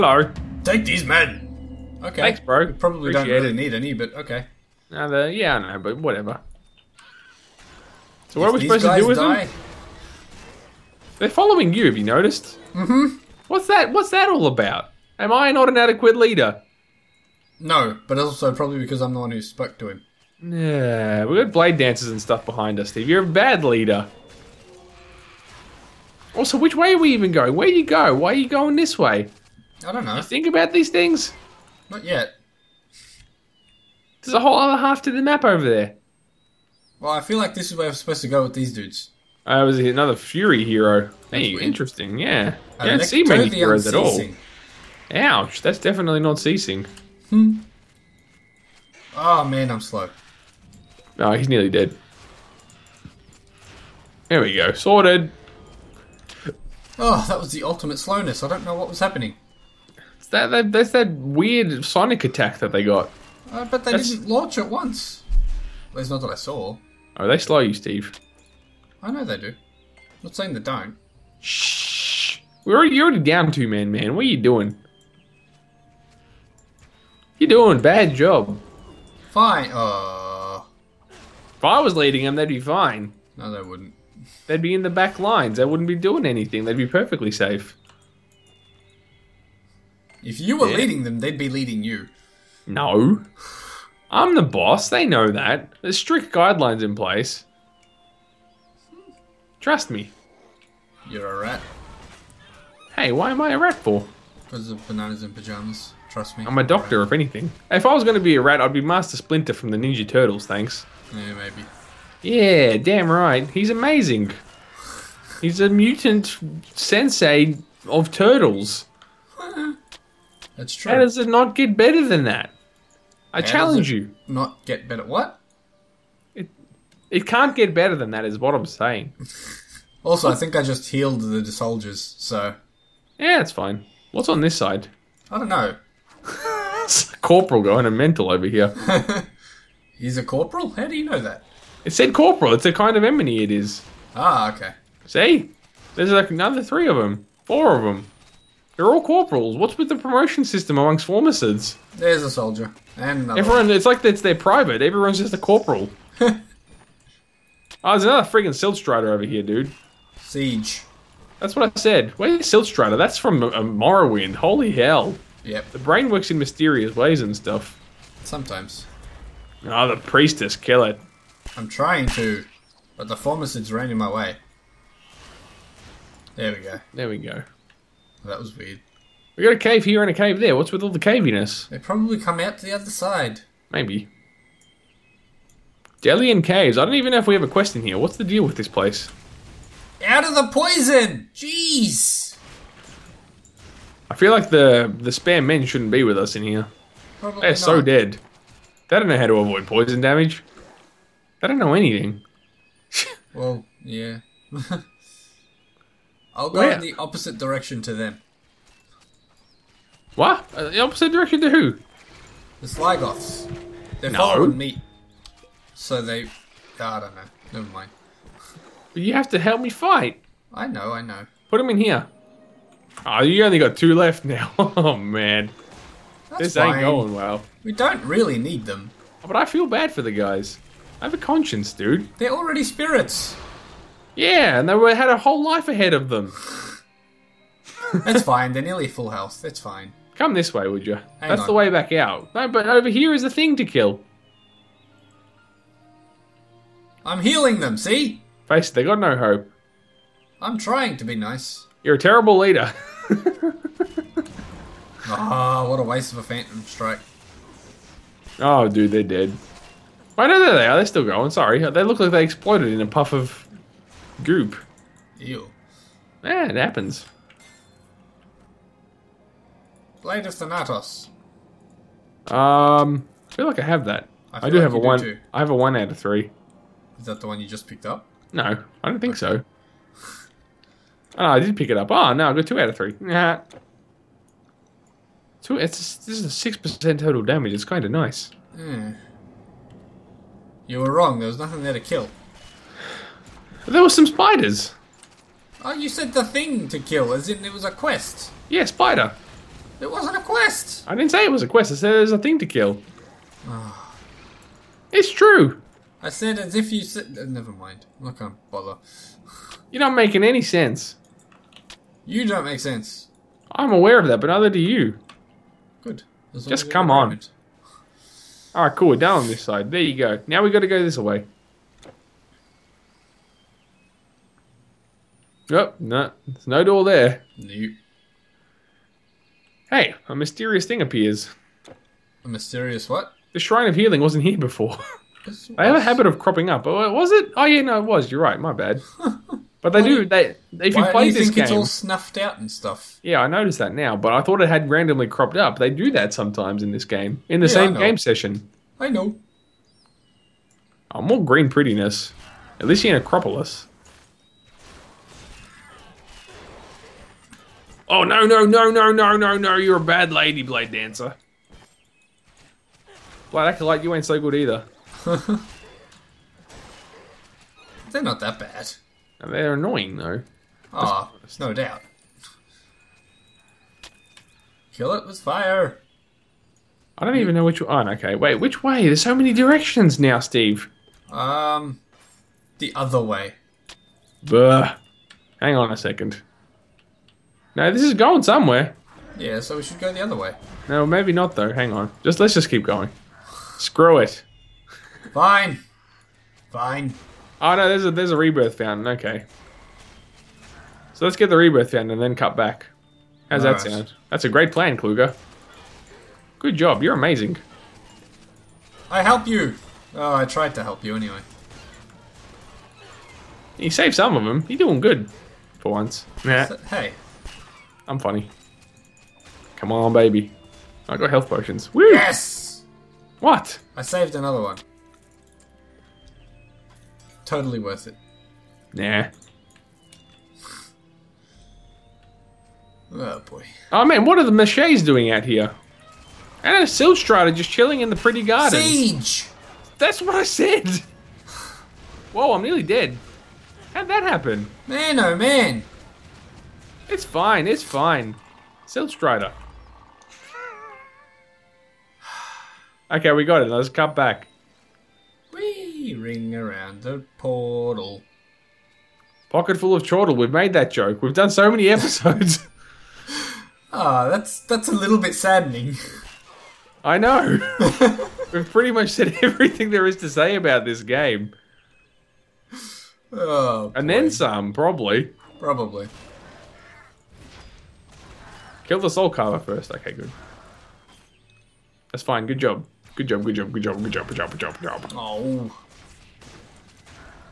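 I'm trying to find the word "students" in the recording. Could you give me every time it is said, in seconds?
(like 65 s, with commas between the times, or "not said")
not said.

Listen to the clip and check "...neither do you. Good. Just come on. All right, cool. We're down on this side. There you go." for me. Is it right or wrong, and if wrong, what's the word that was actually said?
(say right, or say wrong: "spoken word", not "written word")
right.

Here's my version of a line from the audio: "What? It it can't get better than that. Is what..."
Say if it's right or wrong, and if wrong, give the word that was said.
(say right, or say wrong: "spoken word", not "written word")
right.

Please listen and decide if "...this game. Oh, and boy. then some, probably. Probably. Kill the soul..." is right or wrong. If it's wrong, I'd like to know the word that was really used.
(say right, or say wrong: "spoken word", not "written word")
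right.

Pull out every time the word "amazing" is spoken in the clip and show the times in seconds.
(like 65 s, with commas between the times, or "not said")
113 s, 406 s.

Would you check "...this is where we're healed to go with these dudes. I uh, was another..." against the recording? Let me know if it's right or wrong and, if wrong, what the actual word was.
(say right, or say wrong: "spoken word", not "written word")
wrong: "supposed", not "healed".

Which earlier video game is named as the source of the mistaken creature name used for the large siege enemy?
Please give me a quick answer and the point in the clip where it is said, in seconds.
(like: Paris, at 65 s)
Morrowind, at 163 s.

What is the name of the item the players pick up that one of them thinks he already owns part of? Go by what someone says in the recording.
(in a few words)
Blade of Thanatos.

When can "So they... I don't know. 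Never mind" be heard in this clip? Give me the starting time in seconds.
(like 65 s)
215 s.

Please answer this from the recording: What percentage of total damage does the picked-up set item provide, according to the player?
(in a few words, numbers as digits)
6%.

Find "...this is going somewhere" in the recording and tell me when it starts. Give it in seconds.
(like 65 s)
387 s.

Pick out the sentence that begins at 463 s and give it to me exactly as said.
Ah, oh, that's that's a little bit saddening.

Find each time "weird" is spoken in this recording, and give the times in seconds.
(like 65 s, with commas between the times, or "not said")
41 s, 61 s, 178 s.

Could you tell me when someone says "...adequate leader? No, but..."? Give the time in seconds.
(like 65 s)
15 s.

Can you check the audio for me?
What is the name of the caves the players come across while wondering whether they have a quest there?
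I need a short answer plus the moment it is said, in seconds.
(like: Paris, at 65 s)
Delian Caves, at 186 s.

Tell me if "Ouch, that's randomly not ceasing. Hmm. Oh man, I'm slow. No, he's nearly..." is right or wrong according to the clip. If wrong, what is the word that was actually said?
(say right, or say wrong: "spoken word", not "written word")
wrong: "definitely", not "randomly".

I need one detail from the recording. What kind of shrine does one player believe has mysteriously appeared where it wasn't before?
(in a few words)
Shrine of Healing.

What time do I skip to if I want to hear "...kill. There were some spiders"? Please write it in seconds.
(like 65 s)
291 s.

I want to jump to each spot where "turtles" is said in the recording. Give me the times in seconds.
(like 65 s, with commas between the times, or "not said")
110 s, 118 s.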